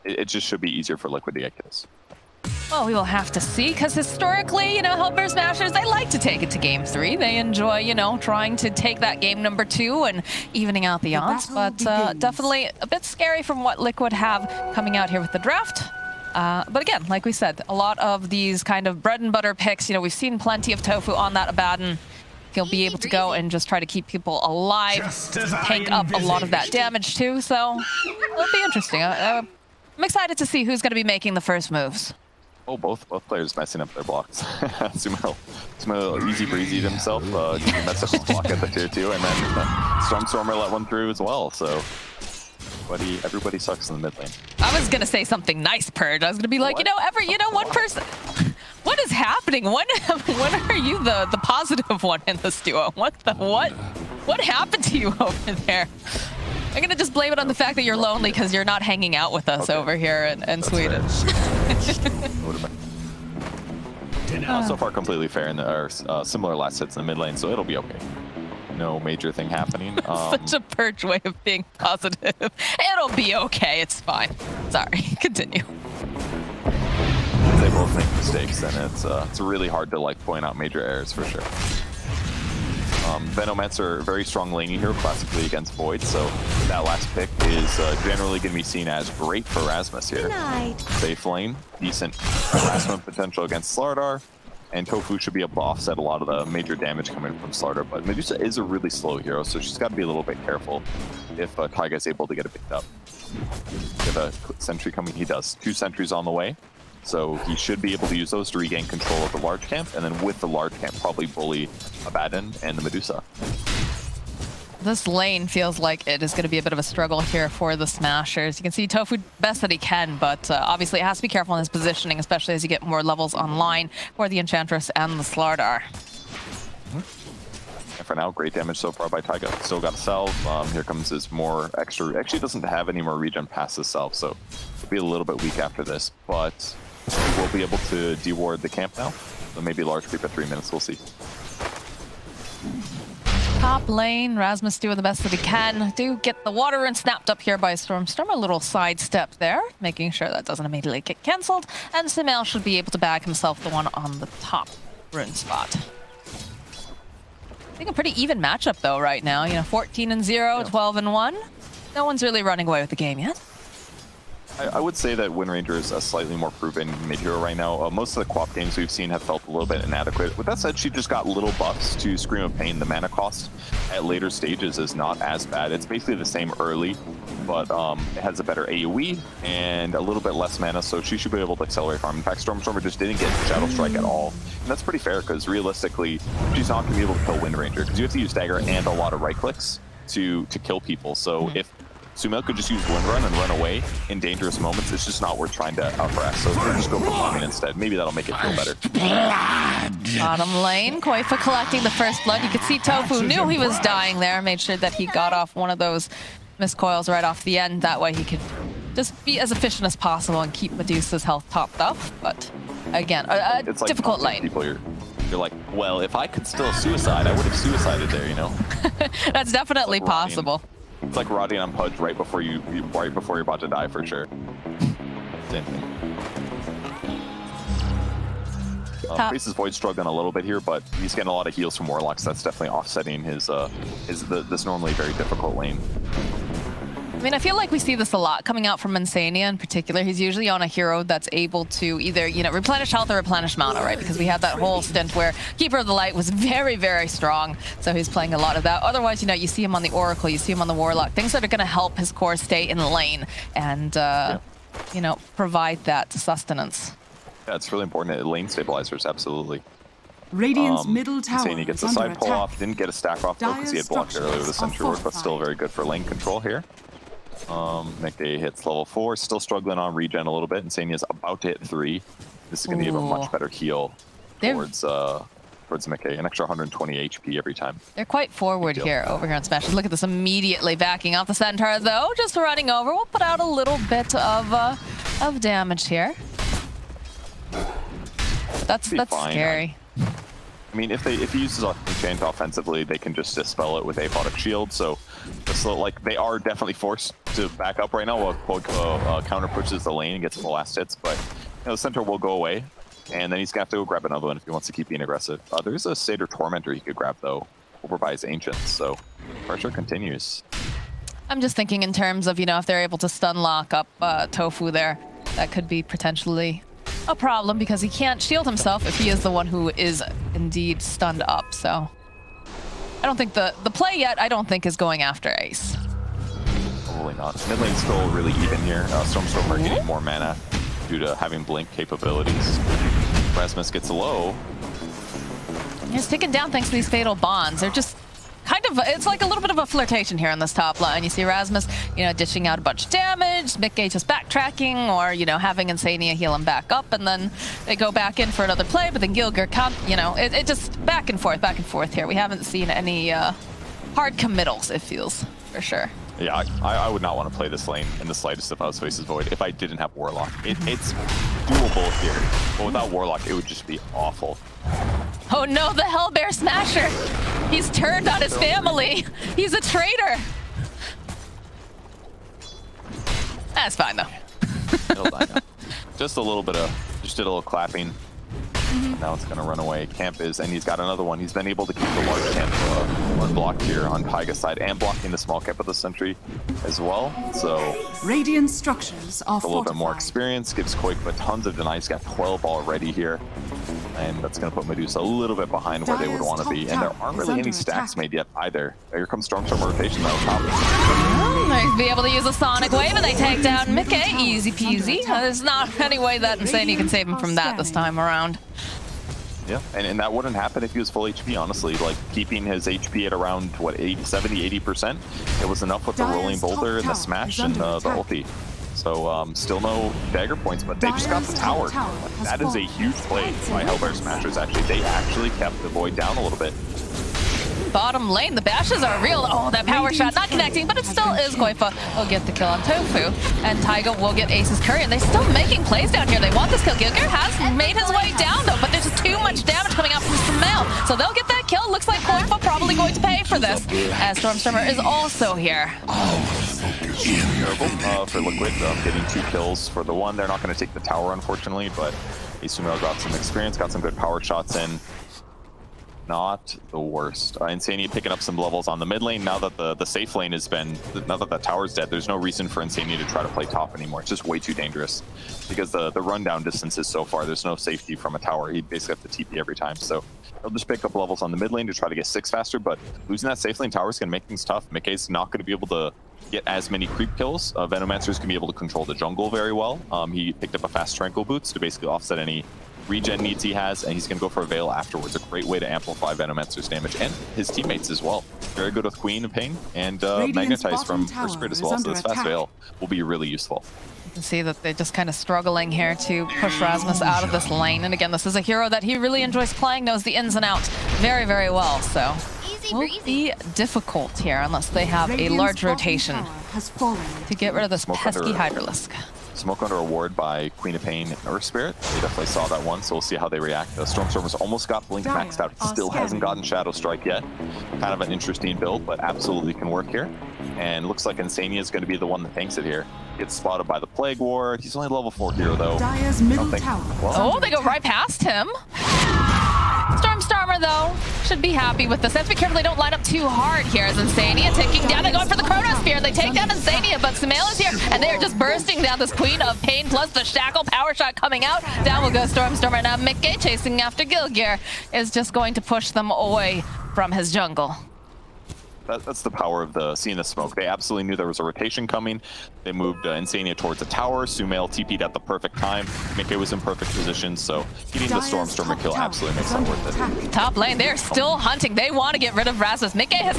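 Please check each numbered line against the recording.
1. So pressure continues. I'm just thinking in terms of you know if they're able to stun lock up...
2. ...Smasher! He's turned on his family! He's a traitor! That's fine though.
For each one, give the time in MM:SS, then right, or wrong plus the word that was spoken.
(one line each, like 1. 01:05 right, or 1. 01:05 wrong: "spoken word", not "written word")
1. 05:08 right
2. 06:06 right.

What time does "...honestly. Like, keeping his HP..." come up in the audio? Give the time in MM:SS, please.
06:51.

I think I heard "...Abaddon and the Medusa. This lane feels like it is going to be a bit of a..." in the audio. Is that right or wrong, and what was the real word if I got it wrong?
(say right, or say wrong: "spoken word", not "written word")
right.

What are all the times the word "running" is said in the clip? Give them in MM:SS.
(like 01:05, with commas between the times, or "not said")
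02:42, 04:42.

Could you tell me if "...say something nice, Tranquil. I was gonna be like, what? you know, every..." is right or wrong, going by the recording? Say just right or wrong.
wrong.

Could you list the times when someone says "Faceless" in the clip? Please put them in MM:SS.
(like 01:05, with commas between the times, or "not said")
05:58.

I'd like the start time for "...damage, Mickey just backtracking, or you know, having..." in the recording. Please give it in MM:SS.
05:42.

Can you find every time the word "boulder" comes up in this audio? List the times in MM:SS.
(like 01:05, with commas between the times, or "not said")
06:56.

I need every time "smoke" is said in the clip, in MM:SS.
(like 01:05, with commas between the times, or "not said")
08:29, 09:10.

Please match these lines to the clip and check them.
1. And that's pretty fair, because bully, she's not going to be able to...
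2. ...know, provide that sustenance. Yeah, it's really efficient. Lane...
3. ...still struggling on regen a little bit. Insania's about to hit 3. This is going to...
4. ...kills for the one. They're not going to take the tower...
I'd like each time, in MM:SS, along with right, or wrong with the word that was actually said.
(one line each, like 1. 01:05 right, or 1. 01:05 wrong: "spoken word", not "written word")
1. 03:04 wrong: "realistically", not "bully"
2. 04:15 wrong: "important", not "efficient"
3. 04:29 right
4. 07:29 right.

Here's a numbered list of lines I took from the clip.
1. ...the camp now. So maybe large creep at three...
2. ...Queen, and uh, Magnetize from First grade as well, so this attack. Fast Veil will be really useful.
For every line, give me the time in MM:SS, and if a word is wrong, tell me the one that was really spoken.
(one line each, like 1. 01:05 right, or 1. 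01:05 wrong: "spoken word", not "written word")
1. 02:18 right
2. 08:08 right.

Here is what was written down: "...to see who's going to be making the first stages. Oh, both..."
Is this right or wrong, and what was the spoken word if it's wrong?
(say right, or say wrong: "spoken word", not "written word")
wrong: "moves", not "stages".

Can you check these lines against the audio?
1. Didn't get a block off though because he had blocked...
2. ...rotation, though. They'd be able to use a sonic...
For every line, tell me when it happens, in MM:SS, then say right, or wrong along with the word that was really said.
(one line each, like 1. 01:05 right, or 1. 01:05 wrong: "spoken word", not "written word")
1. 04:22 wrong: "stack", not "block"
2. 06:39 right.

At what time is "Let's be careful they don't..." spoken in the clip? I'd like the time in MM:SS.
08:52.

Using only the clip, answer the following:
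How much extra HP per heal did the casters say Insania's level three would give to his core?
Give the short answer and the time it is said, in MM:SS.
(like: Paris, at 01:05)
120, at 04:36.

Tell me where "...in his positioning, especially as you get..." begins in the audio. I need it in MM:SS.
02:01.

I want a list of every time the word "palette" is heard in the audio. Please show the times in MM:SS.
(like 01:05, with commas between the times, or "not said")
not said.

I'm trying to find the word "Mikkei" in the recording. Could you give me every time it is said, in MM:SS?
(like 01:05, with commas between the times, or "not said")
07:54, 09:16.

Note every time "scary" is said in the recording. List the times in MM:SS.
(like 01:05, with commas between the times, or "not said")
00:13, 04:49.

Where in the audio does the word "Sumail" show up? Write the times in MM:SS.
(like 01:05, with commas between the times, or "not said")
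02:32, 03:12, 09:14.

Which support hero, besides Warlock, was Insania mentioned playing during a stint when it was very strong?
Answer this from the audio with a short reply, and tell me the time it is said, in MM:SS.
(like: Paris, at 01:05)
Keeper of the Light, at 04:05.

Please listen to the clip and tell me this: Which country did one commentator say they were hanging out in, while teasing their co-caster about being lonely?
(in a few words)
Sweden.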